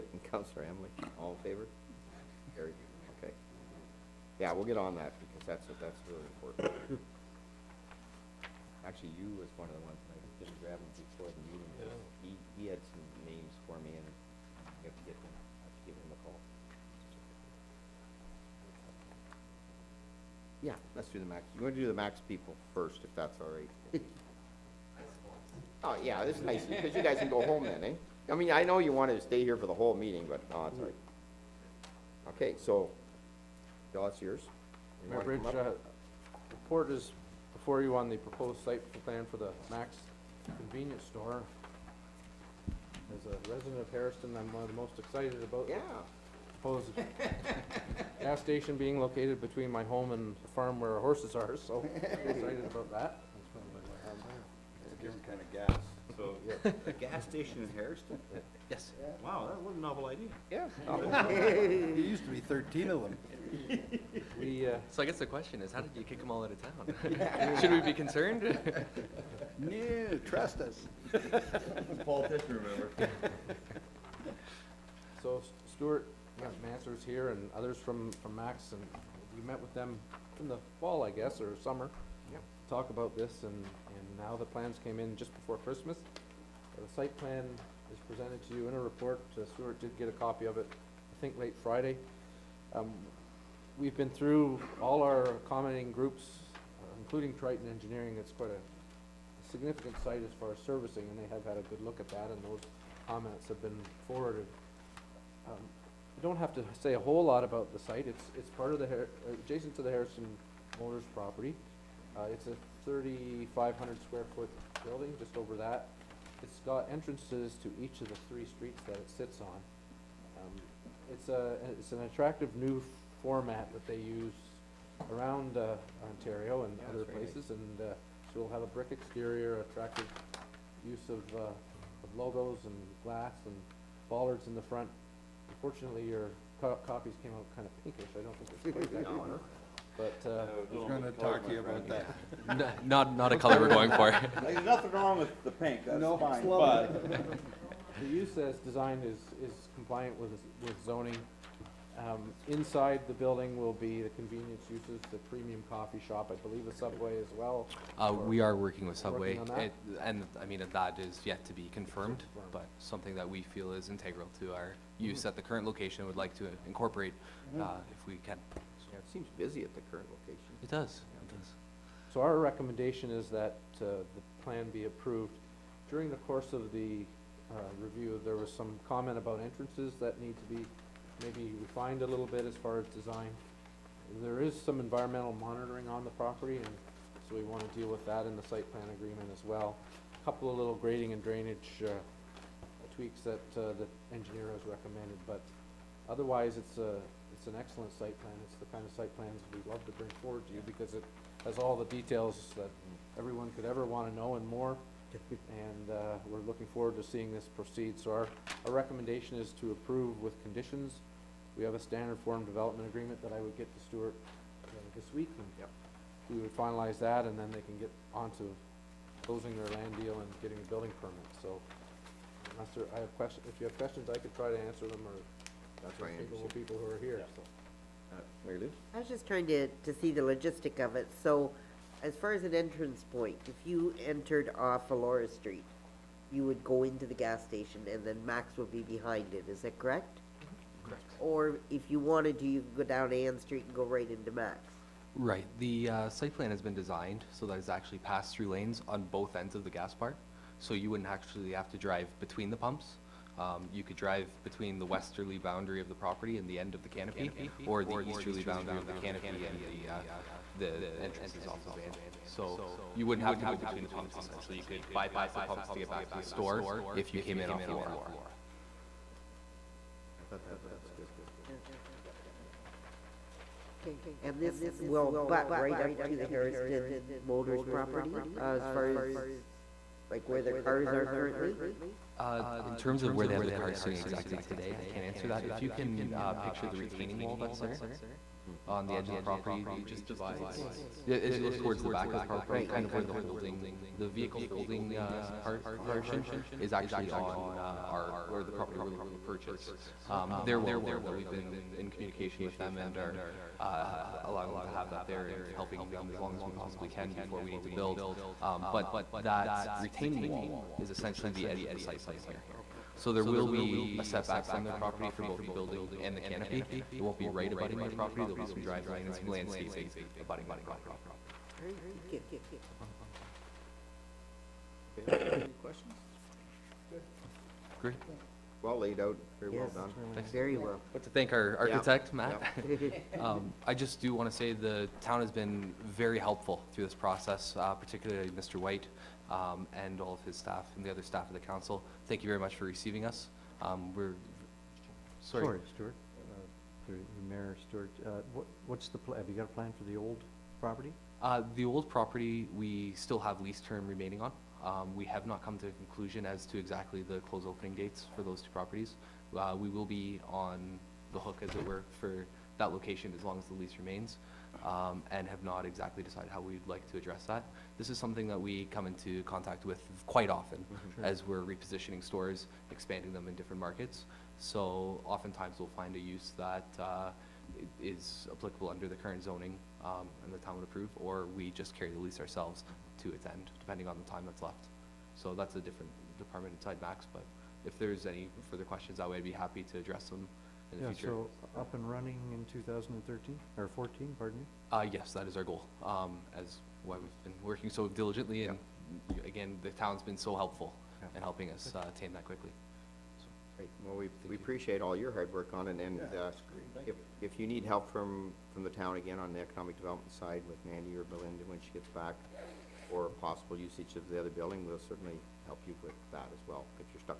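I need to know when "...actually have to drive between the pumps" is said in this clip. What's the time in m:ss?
4:11.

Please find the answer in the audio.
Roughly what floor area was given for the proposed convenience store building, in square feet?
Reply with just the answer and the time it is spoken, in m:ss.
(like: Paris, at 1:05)
3,500, at 1:52.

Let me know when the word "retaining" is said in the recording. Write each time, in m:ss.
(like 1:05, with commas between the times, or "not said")
4:46, 5:09.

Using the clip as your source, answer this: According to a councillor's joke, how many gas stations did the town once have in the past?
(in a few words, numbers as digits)
13.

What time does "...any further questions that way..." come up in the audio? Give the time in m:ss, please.
6:28.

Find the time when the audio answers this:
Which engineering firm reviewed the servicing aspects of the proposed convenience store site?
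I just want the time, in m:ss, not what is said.
1:37.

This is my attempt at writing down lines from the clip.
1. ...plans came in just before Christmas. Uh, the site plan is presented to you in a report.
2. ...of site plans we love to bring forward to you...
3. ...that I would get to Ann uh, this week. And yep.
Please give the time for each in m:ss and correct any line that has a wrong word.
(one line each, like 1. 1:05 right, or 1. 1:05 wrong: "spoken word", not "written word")
1. 1:24 right
2. 3:18 right
3. 3:33 wrong: "Stuart", not "Ann".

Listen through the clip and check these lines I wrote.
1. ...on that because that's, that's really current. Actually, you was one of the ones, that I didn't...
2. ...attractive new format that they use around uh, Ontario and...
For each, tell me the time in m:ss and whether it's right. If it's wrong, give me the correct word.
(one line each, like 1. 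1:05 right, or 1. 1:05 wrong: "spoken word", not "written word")
1. 0:04 wrong: "important", not "current"
2. 2:02 right.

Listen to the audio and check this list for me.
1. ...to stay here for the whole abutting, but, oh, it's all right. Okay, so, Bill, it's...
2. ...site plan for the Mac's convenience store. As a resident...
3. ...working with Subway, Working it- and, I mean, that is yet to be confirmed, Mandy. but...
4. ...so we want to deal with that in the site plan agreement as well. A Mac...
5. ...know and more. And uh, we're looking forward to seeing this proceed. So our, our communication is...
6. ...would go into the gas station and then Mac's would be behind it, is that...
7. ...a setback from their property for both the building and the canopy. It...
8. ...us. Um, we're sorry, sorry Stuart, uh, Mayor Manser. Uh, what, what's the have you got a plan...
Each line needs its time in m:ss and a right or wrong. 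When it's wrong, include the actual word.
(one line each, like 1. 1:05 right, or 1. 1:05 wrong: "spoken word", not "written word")
1. 0:29 wrong: "meeting", not "abutting"
2. 0:38 right
3. 2:38 wrong: "Confirmed", not "Mandy"
4. 3:07 wrong: "Couple", not "Mac"
5. 3:24 wrong: "recommendation", not "communication"
6. 3:56 right
7. 5:13 right
8. 5:43 wrong: "Stuart", not "Manser".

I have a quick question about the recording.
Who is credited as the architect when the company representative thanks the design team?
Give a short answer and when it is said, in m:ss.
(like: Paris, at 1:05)
Matt, at 5:32.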